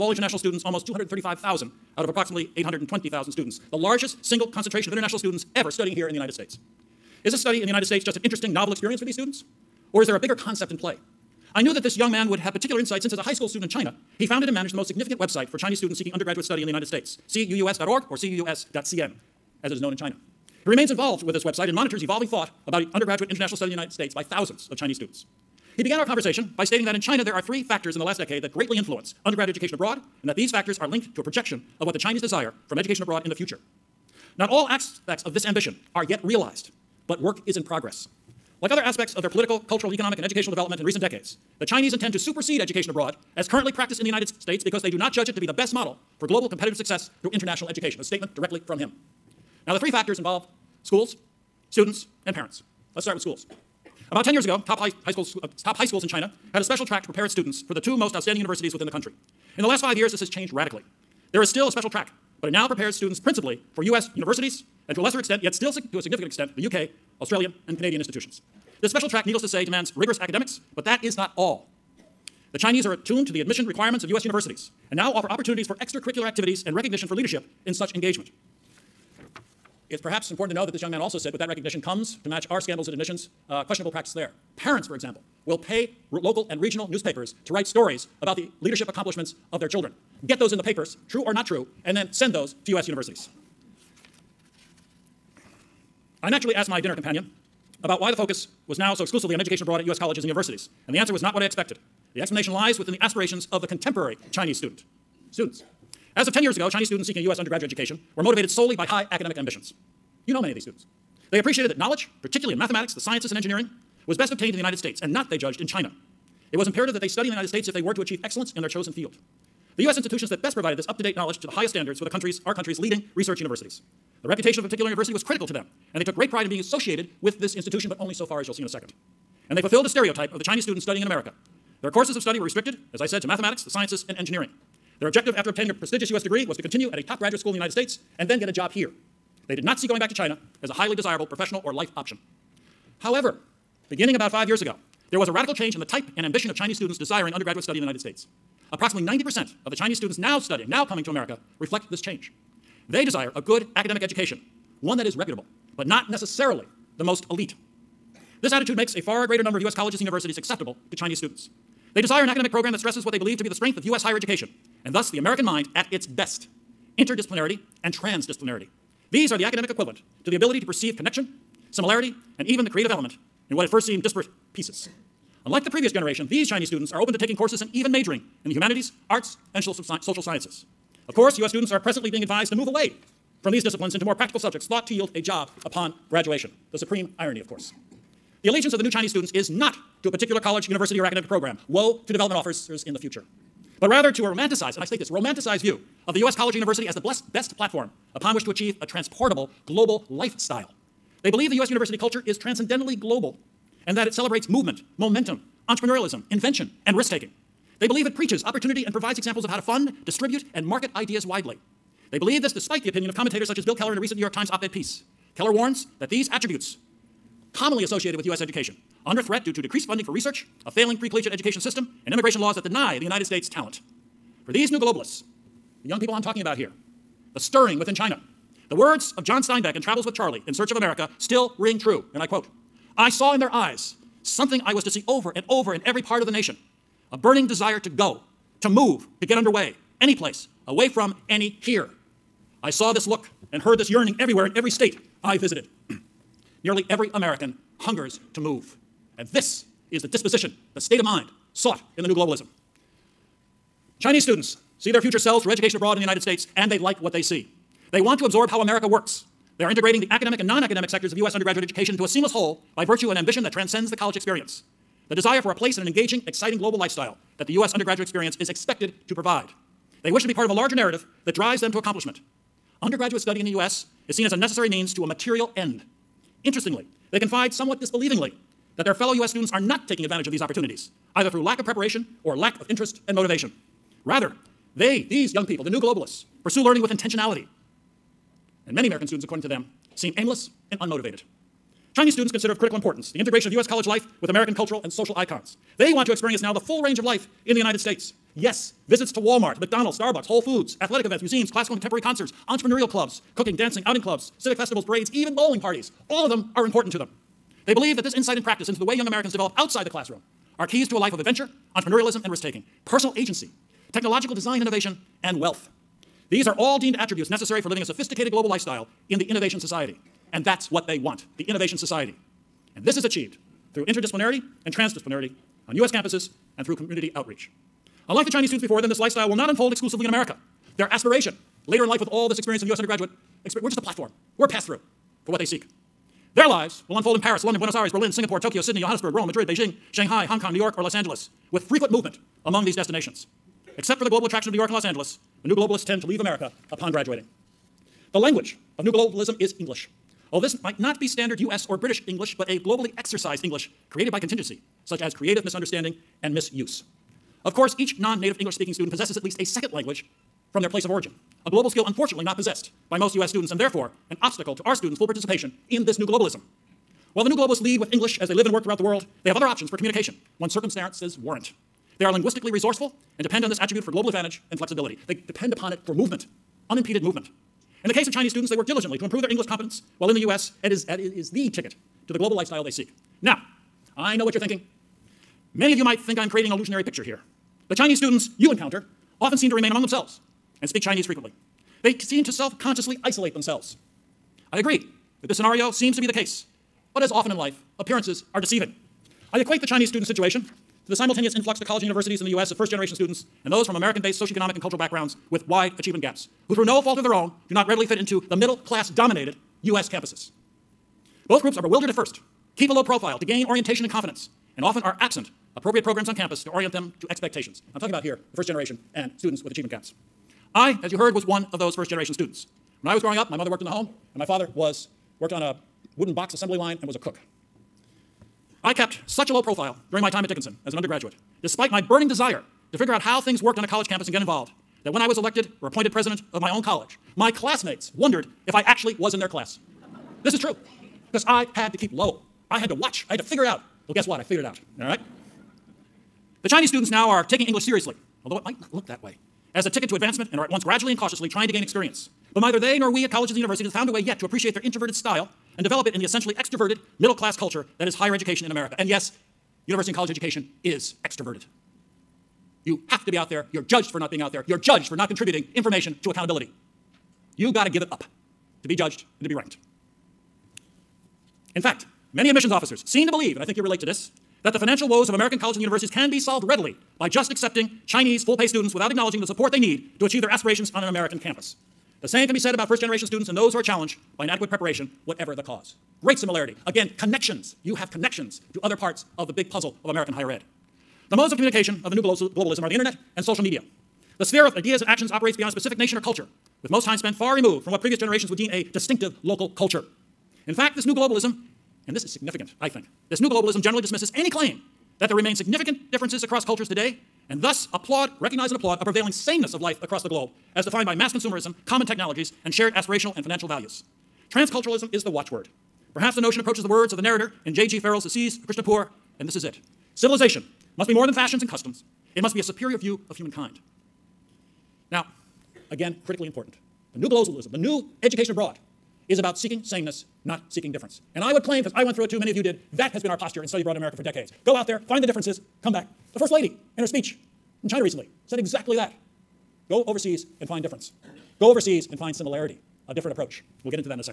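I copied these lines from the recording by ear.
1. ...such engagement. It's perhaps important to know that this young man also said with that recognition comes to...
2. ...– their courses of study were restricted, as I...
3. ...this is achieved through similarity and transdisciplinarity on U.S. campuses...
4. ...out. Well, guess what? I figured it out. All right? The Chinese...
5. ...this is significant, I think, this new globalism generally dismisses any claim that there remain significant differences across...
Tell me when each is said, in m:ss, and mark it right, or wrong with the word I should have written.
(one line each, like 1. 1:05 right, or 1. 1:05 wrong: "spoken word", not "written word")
1. 1:17 right
2. 2:11 right
3. 5:22 wrong: "interdisciplinarity", not "similarity"
4. 7:23 right
5. 8:21 right.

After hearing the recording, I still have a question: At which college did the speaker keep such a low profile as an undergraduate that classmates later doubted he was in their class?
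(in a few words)
Dickinson.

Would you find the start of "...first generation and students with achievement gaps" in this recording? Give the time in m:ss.
6:58.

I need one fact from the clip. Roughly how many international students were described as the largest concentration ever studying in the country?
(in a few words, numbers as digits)
235,000.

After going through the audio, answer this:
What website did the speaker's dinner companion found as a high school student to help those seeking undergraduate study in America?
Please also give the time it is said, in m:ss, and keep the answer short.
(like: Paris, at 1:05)
cuus.org, at 0:17.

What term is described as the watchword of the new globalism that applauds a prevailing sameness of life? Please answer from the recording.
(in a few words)
Transculturalism.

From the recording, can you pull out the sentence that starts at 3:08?
The allegiance of the new Chinese students is not to a particular college, university, or academic program.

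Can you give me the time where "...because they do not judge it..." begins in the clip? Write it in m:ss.
0:44.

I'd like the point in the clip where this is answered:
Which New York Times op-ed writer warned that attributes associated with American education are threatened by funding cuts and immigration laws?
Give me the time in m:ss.
3:33.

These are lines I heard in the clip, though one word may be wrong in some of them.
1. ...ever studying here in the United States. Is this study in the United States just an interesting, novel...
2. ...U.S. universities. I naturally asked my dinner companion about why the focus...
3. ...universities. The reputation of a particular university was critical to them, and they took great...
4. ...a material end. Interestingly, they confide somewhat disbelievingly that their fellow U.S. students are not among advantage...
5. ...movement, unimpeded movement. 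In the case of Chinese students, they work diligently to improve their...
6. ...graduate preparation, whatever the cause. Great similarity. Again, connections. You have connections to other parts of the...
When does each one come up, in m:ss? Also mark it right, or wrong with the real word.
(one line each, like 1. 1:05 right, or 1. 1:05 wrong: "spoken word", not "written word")
1. 0:05 right
2. 1:32 right
3. 2:03 right
4. 4:35 wrong: "taking", not "among"
5. 6:15 right
6. 8:04 wrong: "inadequate", not "graduate".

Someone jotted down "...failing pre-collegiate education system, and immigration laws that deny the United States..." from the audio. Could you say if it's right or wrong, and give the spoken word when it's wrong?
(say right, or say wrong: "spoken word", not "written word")
right.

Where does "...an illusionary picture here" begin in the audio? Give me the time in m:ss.
6:26.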